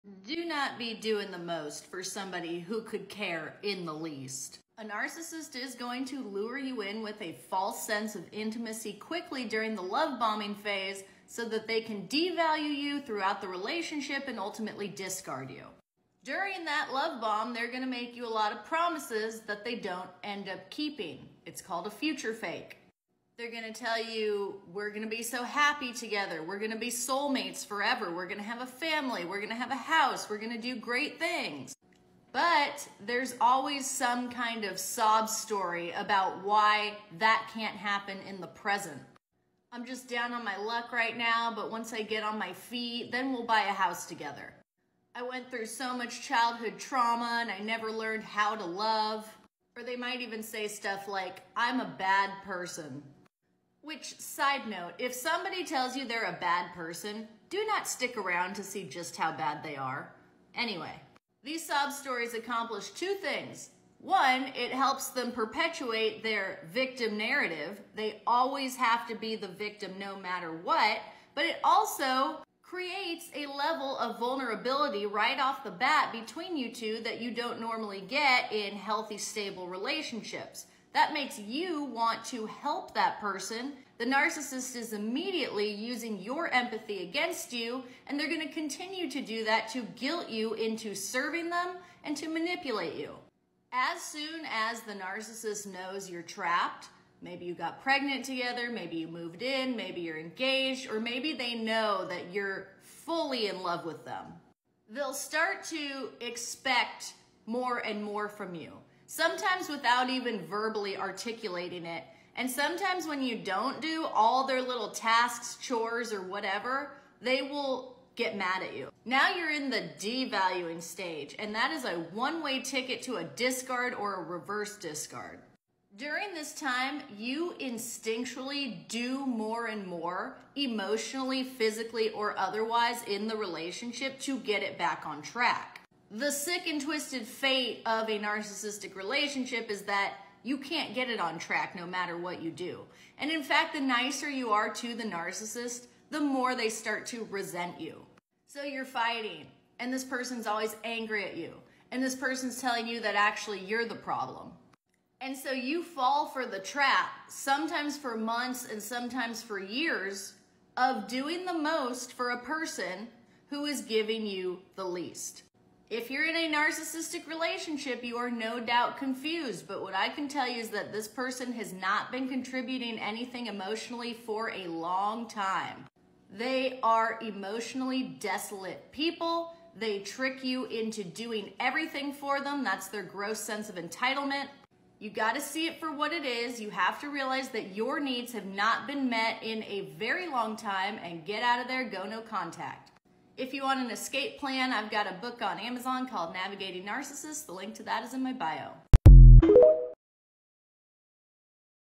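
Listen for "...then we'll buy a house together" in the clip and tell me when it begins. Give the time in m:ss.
0:43.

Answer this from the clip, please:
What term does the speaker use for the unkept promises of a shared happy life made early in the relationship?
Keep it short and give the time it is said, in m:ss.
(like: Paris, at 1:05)
Future fake, at 0:21.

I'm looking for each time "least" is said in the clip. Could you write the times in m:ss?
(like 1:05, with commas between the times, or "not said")
0:03, 2:44.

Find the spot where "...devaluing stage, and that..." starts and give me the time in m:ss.
1:59.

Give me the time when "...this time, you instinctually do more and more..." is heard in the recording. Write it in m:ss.
2:06.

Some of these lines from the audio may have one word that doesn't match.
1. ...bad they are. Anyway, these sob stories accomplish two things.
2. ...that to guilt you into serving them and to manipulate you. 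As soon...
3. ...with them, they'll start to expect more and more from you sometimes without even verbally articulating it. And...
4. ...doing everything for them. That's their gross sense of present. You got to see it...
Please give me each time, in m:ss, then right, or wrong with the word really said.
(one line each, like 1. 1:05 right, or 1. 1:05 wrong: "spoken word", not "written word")
1. 0:59 right
2. 1:29 right
3. 1:43 right
4. 3:01 wrong: "entitlement", not "present".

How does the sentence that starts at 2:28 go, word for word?
So you're fighting, and this person's always angry at you, and this person's telling you that actually you're the problem.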